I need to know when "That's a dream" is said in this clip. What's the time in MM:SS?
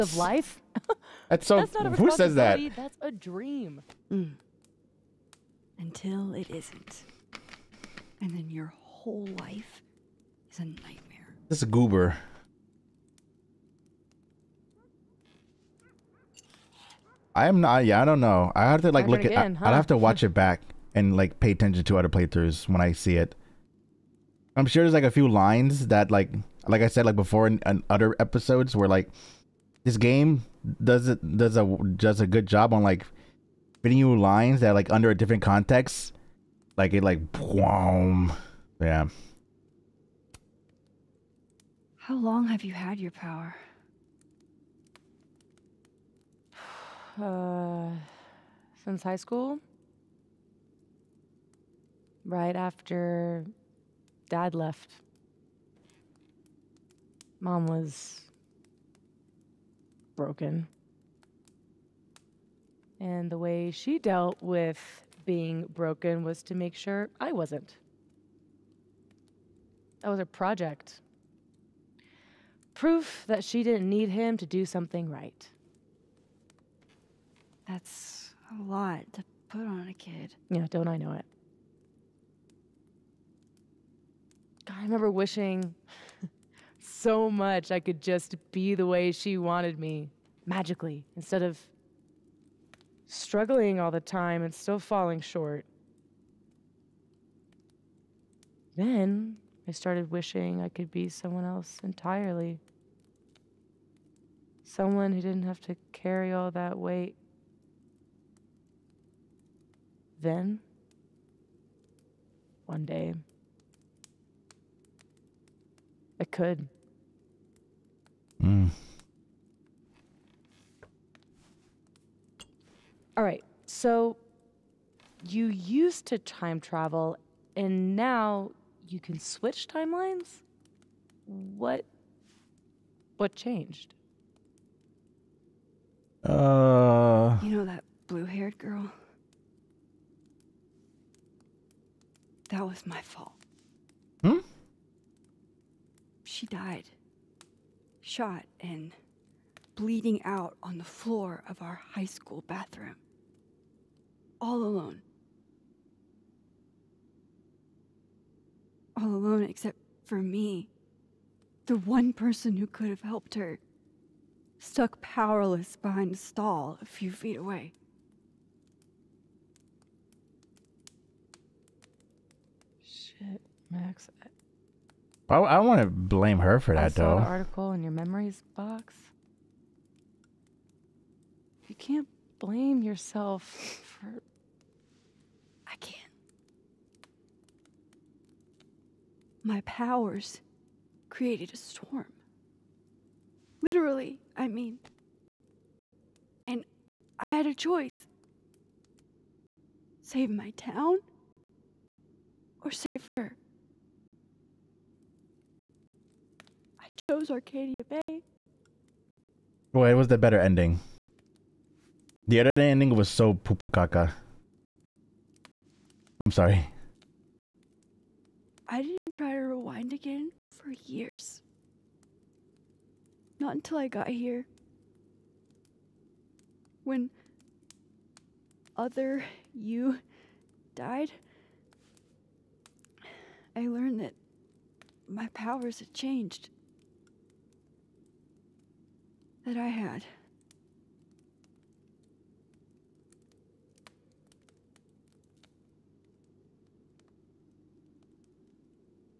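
00:02.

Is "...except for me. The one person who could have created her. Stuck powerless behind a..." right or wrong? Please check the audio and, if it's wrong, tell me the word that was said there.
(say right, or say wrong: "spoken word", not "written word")
wrong: "helped", not "created".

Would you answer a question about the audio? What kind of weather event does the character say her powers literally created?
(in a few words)
A storm.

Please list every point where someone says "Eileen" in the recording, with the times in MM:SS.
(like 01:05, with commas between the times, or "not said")
not said.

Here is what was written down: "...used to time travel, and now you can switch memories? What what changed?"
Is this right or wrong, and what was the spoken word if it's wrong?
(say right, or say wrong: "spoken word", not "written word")
wrong: "timelines", not "memories".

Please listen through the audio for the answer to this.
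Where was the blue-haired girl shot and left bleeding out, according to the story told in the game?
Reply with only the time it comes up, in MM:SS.
02:31.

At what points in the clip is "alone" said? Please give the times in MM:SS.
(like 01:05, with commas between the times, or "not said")
02:34, 02:39.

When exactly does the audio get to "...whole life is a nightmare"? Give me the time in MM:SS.
00:09.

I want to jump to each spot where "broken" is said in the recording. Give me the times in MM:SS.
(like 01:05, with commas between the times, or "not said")
01:00, 01:05.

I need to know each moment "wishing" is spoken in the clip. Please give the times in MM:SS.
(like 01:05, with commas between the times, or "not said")
01:25, 01:40.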